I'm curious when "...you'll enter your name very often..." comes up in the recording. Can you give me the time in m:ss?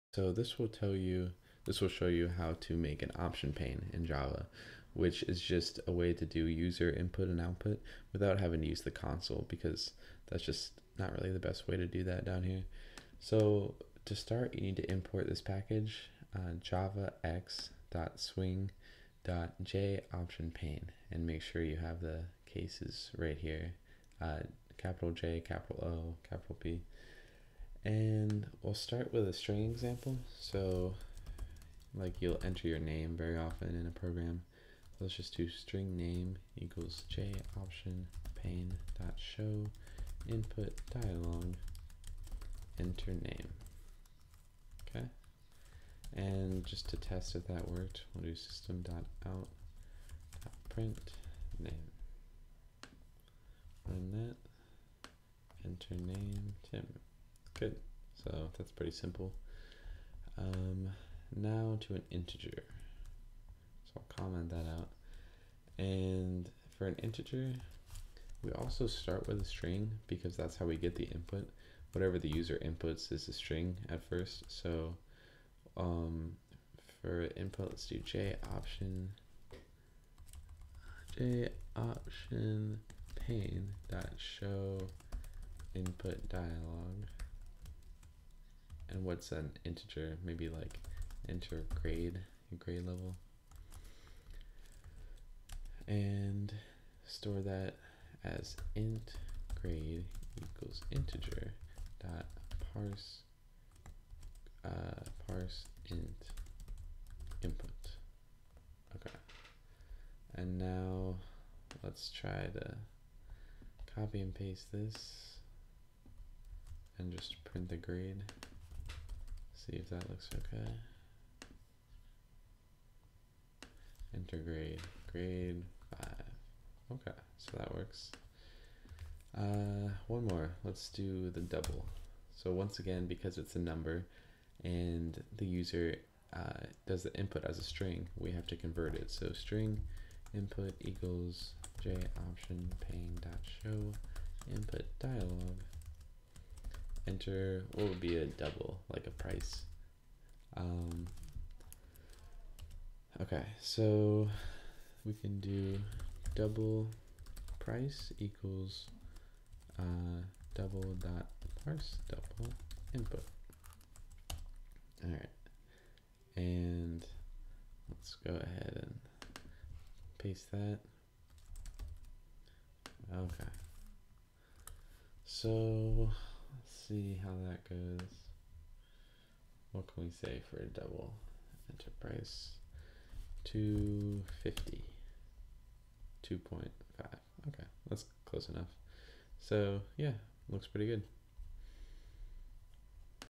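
0:32.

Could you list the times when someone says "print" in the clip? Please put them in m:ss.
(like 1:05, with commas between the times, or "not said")
0:50, 1:57.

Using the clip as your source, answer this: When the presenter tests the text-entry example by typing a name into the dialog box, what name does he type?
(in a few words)
Tim.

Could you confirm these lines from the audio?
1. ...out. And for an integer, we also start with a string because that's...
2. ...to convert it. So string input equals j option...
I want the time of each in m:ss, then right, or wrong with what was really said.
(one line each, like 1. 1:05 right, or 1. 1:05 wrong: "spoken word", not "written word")
1. 1:04 right
2. 2:18 right.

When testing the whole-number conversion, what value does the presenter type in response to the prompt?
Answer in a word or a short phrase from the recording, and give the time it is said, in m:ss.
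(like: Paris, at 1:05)
5, at 2:05.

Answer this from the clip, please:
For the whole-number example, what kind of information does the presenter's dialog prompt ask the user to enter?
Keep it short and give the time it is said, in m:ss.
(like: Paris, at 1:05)
grade level, at 1:32.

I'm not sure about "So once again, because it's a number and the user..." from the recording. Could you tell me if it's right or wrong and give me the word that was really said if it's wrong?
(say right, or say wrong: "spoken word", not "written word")
right.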